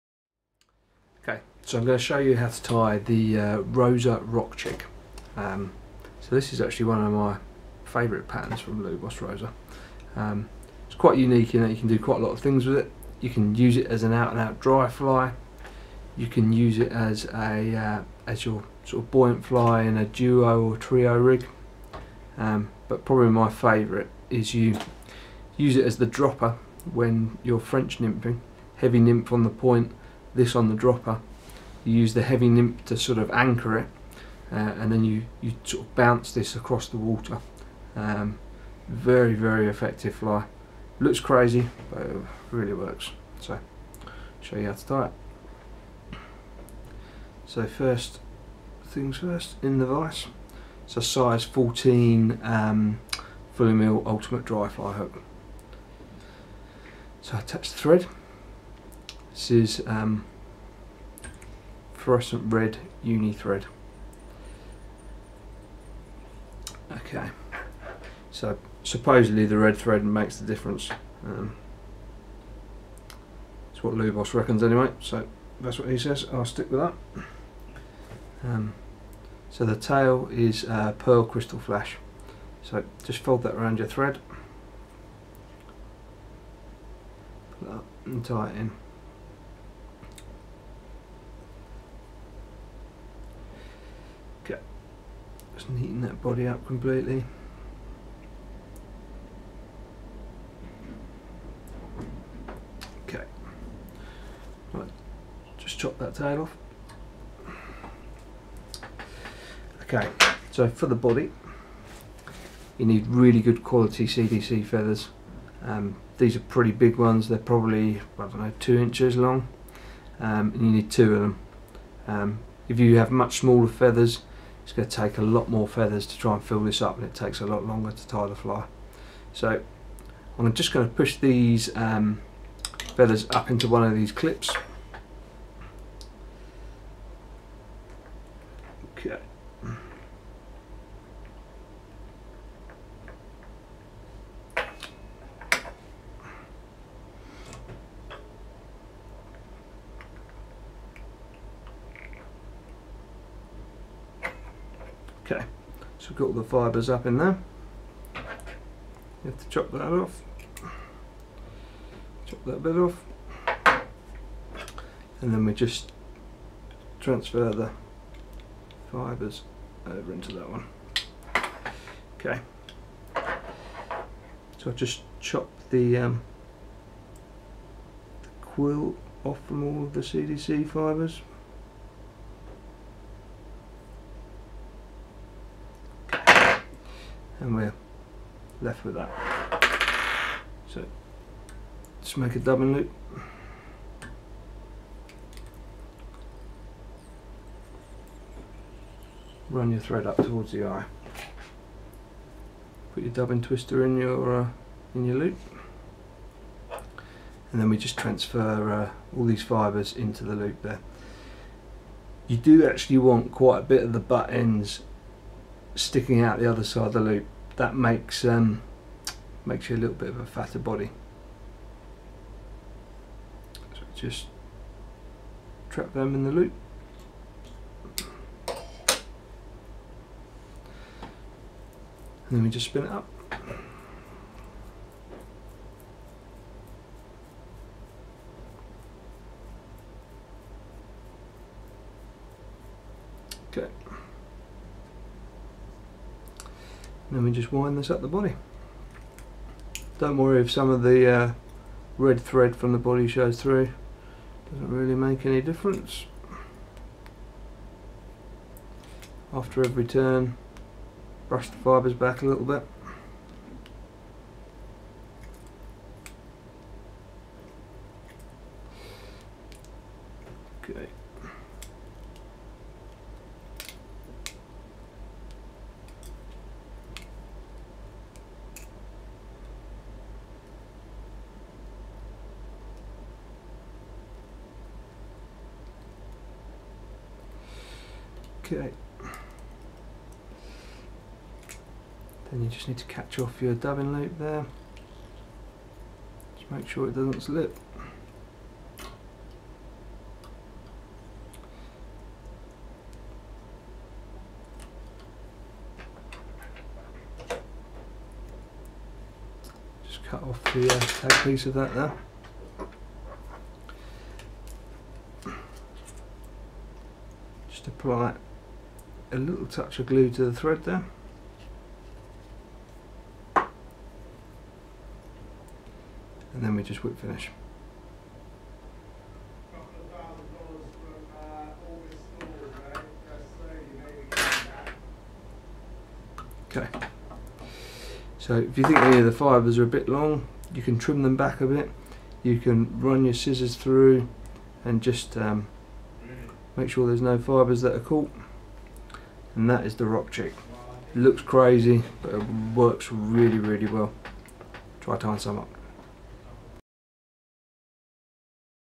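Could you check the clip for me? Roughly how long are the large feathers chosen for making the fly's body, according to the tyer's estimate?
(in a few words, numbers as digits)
2 inches.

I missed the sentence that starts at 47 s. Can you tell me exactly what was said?
So first things first, in the vise.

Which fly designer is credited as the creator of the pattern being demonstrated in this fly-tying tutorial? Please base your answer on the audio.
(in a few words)
Lubos Roza.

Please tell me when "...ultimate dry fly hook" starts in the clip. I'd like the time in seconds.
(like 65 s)
54 s.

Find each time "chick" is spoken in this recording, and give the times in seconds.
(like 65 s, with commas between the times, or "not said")
4 s, 350 s.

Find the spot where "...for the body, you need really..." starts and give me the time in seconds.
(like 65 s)
110 s.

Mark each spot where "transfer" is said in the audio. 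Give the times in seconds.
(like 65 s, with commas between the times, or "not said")
166 s, 207 s.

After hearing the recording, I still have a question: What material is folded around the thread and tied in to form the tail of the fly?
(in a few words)
Pearl crystal flash.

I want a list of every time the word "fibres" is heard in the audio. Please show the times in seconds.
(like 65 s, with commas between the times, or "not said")
156 s, 168 s, 180 s, 209 s, 261 s.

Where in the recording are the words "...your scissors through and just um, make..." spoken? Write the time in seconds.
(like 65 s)
343 s.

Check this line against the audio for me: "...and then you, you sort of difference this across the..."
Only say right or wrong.
wrong.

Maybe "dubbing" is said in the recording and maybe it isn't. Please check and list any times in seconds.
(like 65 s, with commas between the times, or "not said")
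192 s, 203 s, 293 s.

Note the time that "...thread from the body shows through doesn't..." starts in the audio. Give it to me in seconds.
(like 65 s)
252 s.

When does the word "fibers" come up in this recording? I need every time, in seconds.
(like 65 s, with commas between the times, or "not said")
339 s, 347 s.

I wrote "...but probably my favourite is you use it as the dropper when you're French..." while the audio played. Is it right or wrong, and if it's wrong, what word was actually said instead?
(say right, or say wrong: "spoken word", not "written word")
right.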